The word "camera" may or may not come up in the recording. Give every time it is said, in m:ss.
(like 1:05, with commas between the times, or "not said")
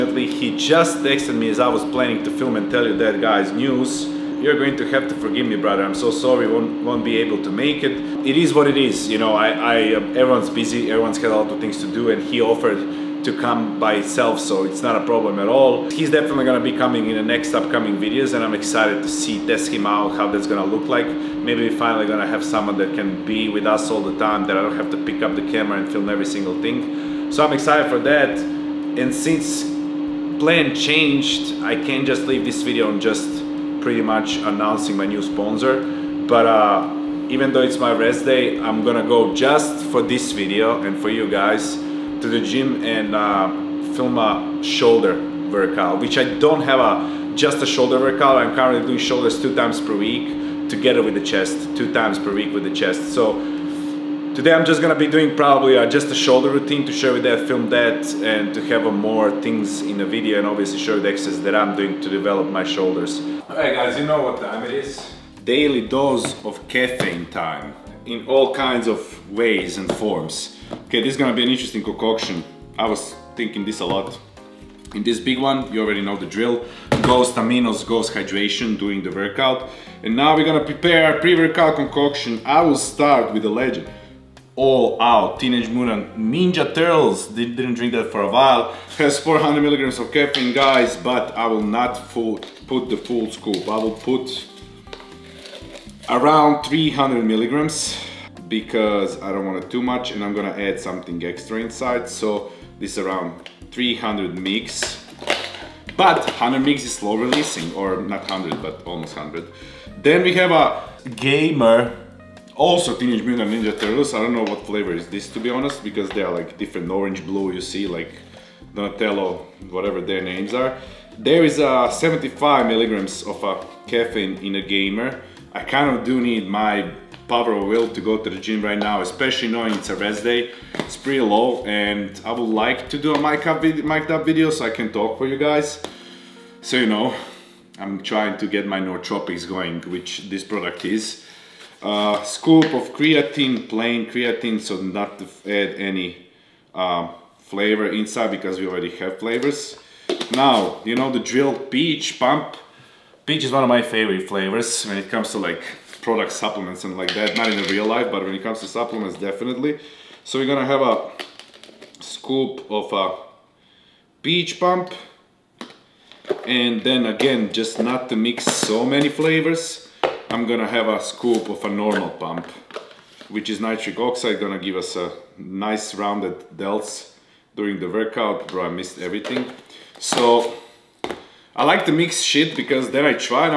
0:25.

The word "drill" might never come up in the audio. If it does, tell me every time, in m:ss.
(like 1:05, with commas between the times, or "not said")
1:16, 2:31.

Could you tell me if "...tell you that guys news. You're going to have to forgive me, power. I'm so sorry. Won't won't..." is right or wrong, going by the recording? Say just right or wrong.
wrong.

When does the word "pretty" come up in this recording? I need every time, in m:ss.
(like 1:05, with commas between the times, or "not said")
0:33, 2:11.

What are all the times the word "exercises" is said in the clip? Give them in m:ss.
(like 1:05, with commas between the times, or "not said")
1:01.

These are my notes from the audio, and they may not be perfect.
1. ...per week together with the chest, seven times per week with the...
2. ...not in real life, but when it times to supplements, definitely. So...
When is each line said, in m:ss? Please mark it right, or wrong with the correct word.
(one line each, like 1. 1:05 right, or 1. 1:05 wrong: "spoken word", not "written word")
1. 0:49 wrong: "two", not "seven"
2. 2:37 wrong: "comes", not "times".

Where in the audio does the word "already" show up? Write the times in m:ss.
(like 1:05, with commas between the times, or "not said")
1:15, 2:28.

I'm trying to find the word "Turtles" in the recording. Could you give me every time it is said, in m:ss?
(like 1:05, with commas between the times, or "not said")
1:26, 1:53.